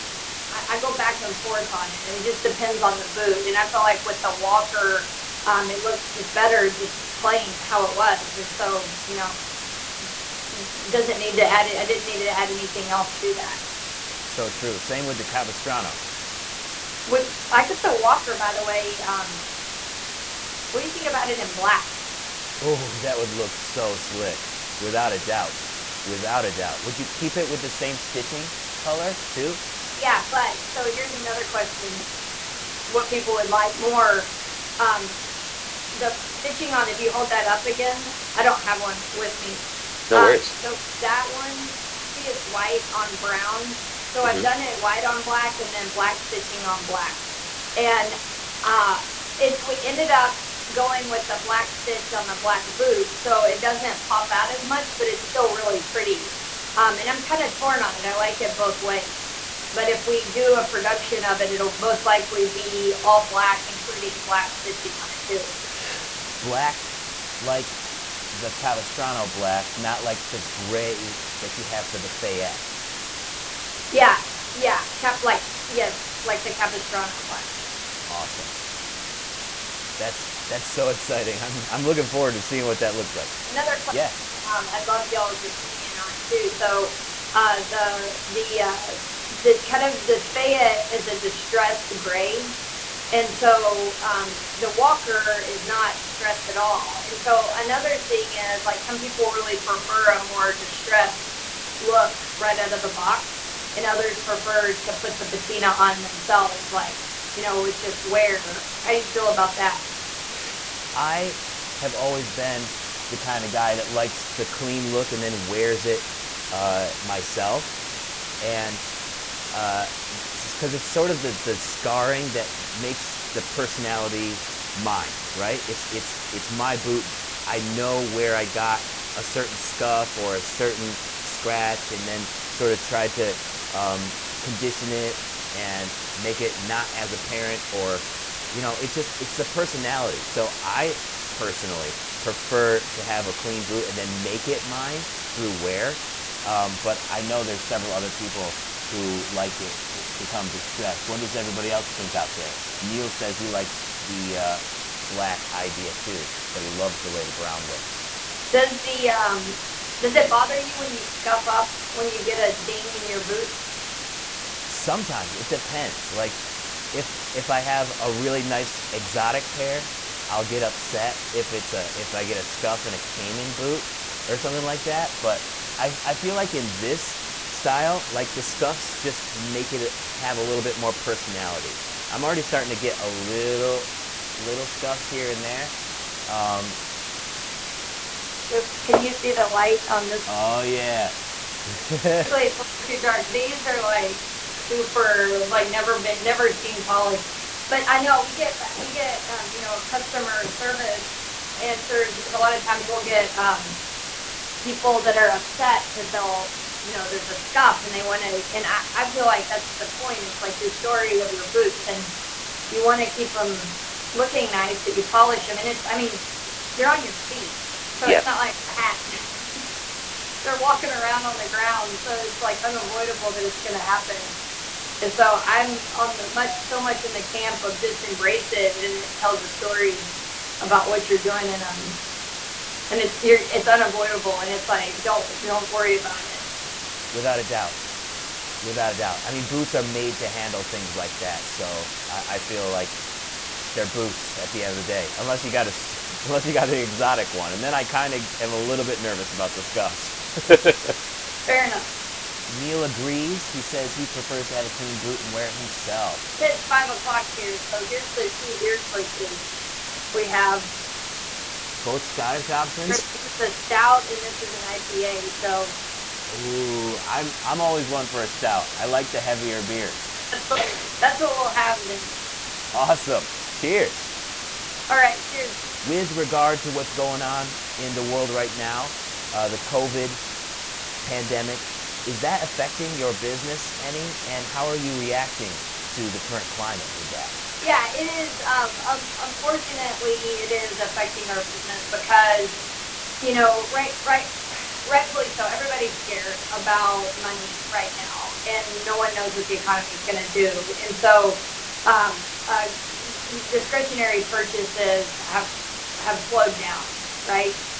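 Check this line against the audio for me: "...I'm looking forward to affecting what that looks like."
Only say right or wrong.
wrong.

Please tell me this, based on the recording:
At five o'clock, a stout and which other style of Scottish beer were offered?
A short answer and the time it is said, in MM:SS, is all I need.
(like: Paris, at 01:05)
IPA, at 04:24.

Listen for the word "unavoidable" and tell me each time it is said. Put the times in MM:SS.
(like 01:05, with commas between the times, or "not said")
03:42, 03:53.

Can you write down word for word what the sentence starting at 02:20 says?
So I personally prefer to have a clean boot and then make it mine through wear.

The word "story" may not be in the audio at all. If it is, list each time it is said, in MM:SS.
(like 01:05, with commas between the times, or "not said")
03:30, 03:49.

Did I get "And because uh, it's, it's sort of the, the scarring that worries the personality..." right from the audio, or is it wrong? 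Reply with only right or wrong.
wrong.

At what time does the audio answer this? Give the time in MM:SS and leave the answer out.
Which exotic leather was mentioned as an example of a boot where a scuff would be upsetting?
02:52.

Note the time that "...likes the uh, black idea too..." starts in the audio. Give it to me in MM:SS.
02:33.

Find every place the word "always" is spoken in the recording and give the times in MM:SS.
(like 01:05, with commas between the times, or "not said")
01:51, 04:27.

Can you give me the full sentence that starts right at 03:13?
These are like super like never been never seen polished.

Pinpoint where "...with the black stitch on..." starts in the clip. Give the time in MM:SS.
00:51.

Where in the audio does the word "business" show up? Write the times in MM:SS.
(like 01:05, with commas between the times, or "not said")
04:43, 04:51.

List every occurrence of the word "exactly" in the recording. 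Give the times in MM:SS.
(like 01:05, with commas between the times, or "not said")
not said.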